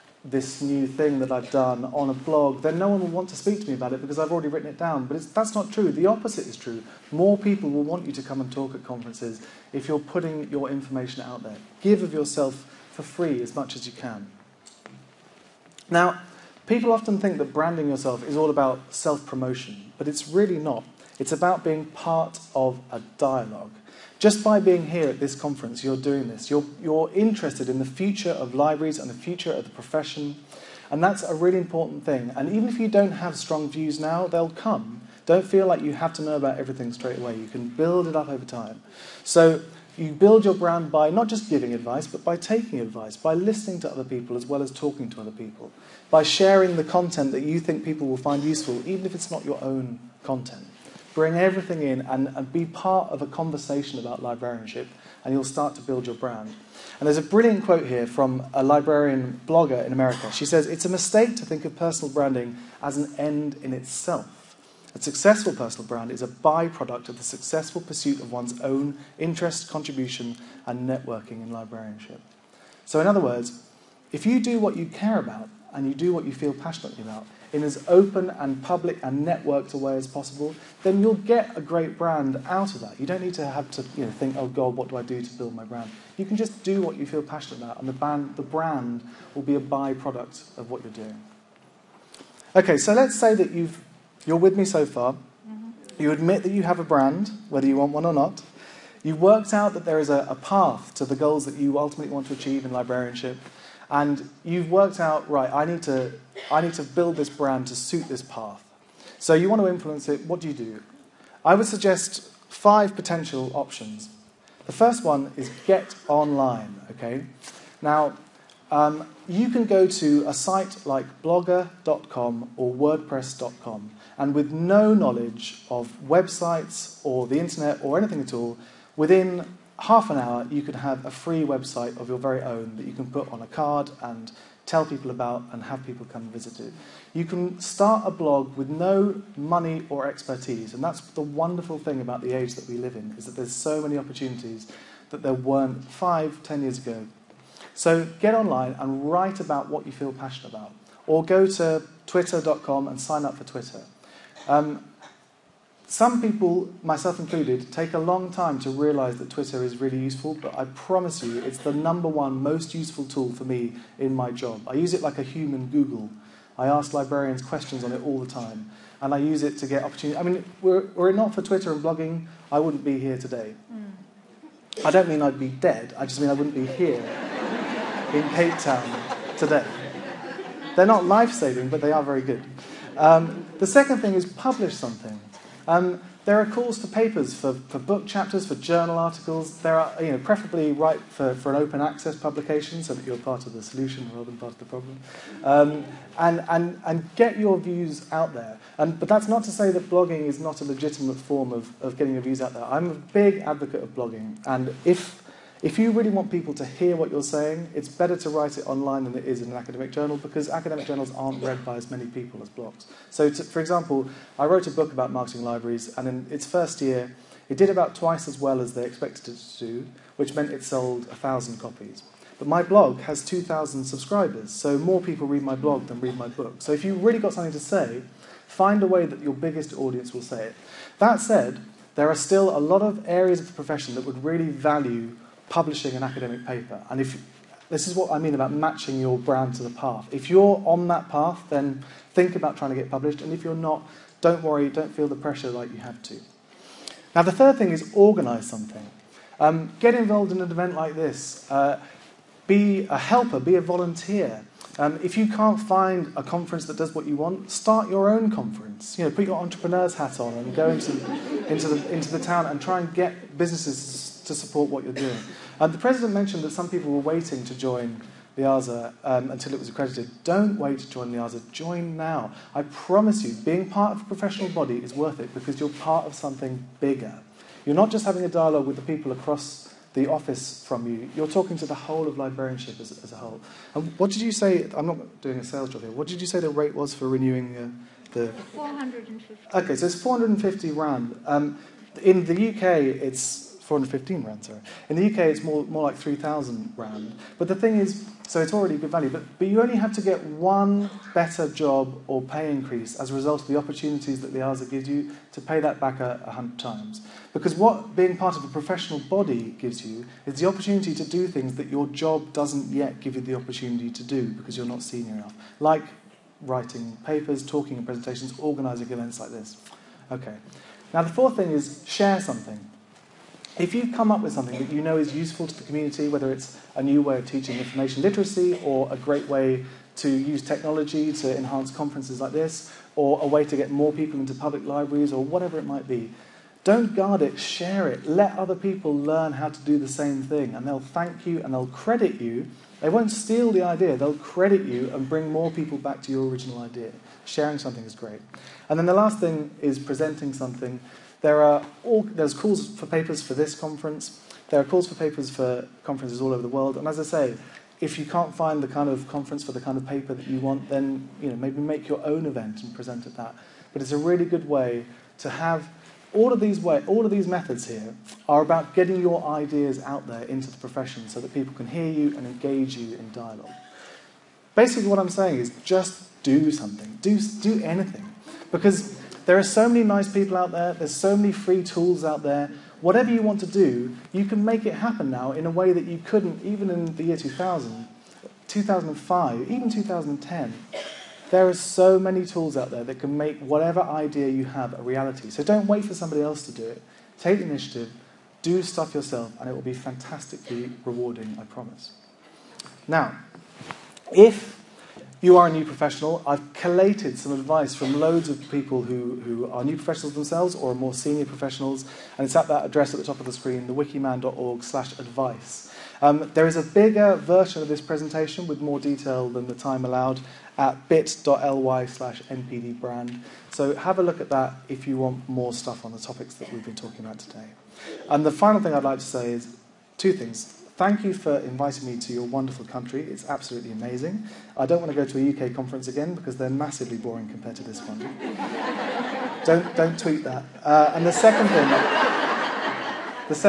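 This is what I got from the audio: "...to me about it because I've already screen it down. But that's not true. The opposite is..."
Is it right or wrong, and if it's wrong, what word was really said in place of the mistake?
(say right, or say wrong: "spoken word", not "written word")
wrong: "written", not "screen".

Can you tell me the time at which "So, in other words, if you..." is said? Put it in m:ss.
1:12.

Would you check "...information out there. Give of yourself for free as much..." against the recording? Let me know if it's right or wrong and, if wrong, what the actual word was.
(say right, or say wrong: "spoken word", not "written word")
right.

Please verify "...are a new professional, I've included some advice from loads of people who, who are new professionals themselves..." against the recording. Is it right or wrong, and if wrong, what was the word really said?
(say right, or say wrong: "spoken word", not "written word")
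wrong: "collated", not "included".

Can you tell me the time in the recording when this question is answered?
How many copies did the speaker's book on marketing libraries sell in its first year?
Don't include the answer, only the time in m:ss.
3:41.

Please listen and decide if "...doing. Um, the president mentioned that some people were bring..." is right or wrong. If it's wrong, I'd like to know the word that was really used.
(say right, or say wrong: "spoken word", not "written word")
wrong: "waiting", not "bring".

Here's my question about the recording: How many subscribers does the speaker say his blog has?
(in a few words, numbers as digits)
2,000.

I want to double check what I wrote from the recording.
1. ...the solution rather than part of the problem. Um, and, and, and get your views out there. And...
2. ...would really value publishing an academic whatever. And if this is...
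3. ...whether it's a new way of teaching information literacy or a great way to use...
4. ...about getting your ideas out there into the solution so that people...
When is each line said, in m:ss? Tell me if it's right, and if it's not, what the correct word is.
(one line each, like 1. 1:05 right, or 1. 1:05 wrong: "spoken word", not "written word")
1. 3:13 right
2. 3:54 wrong: "paper", not "whatever"
3. 5:26 right
4. 6:08 wrong: "profession", not "solution".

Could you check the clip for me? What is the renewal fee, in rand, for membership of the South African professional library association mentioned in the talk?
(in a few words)
450 rand.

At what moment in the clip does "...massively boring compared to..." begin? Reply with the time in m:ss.
7:16.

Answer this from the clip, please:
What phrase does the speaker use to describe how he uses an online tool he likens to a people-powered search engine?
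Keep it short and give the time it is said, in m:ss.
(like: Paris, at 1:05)
a human Google, at 2:45.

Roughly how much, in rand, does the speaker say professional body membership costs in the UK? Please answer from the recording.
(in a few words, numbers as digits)
3,000 rand.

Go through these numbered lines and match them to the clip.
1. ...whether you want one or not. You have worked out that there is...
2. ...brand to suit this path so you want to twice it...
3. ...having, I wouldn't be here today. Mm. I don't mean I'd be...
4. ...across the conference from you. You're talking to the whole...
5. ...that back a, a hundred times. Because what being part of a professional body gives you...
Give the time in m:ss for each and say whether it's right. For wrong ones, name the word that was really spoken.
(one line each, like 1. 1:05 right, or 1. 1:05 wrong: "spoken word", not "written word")
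1. 1:37 right
2. 1:47 wrong: "influence", not "twice"
3. 2:51 wrong: "blogging", not "having"
4. 4:39 wrong: "office", not "conference"
5. 5:05 right.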